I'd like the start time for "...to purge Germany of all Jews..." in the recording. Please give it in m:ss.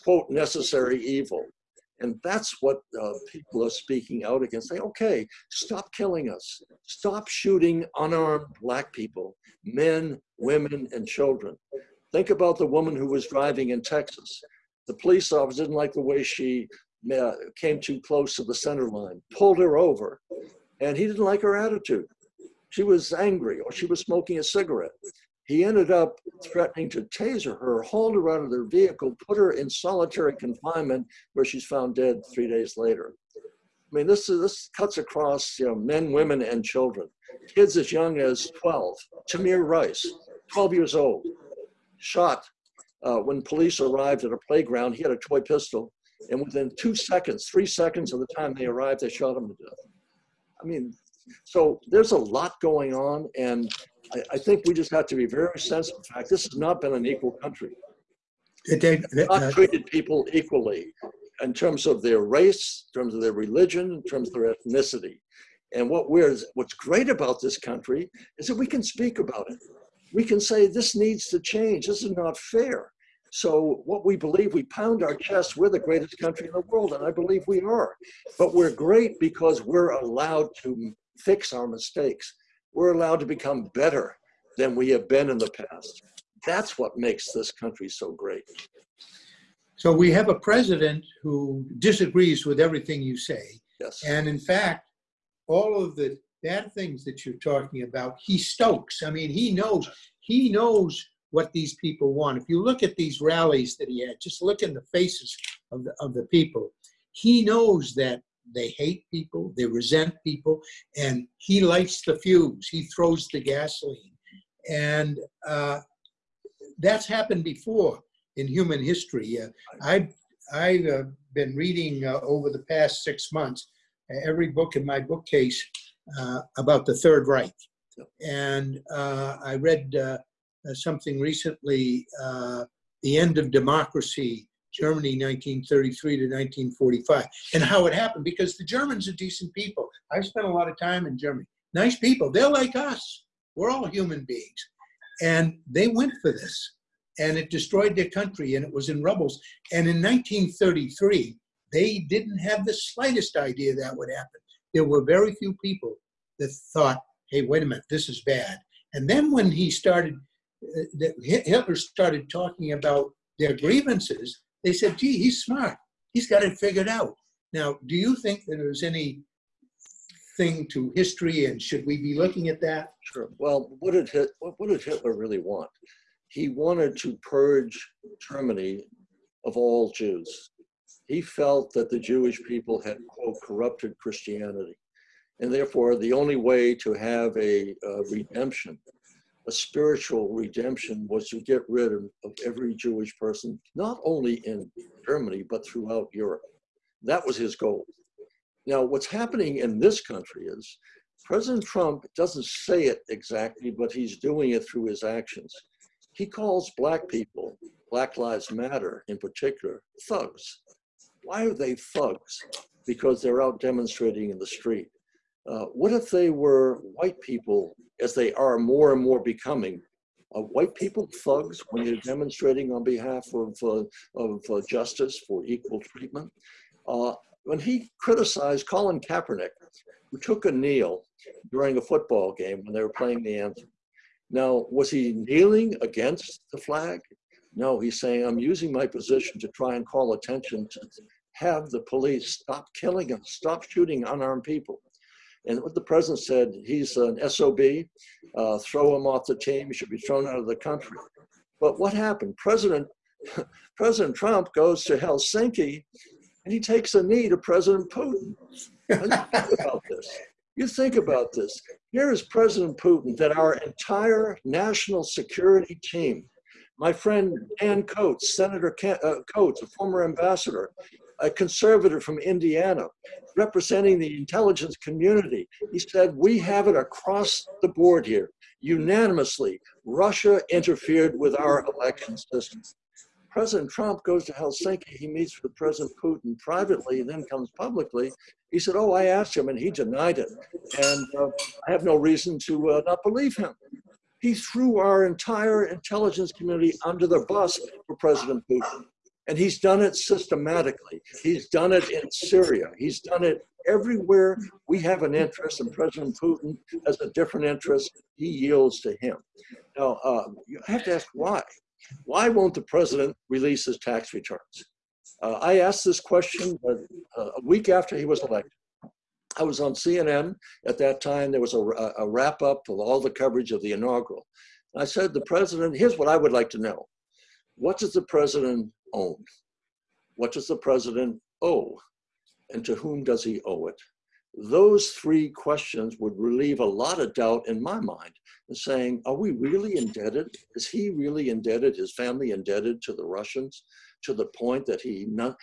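2:56.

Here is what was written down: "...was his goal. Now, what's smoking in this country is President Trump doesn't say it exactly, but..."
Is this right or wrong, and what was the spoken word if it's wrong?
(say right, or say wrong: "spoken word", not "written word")
wrong: "happening", not "smoking".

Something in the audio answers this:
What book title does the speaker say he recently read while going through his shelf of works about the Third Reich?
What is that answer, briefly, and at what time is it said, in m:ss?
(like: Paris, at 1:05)
The End of Democracy, at 2:13.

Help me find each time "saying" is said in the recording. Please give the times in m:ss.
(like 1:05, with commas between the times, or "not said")
3:57, 5:38.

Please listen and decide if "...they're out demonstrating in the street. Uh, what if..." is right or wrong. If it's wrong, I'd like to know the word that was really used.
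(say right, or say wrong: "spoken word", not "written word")
right.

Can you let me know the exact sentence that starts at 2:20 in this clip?
I've spent a lot of time in Germany.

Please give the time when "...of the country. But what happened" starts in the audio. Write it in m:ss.
4:10.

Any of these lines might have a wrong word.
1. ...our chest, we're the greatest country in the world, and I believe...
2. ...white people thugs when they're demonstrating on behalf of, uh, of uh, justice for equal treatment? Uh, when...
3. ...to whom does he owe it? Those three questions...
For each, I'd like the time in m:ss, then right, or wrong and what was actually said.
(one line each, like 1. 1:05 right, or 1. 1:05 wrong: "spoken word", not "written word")
1. 1:15 right
2. 3:40 right
3. 5:32 right.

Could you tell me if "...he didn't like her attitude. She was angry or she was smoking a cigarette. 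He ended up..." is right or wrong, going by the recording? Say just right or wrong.
right.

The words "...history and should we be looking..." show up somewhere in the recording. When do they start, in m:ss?
2:50.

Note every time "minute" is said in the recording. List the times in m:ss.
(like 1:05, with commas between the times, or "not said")
2:37.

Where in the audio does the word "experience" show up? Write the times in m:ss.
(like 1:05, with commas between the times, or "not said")
not said.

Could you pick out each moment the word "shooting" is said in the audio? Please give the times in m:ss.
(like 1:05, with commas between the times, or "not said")
0:07, 4:03.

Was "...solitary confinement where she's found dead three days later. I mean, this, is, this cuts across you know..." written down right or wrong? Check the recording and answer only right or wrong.
right.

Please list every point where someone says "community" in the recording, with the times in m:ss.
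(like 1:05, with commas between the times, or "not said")
4:34, 4:56.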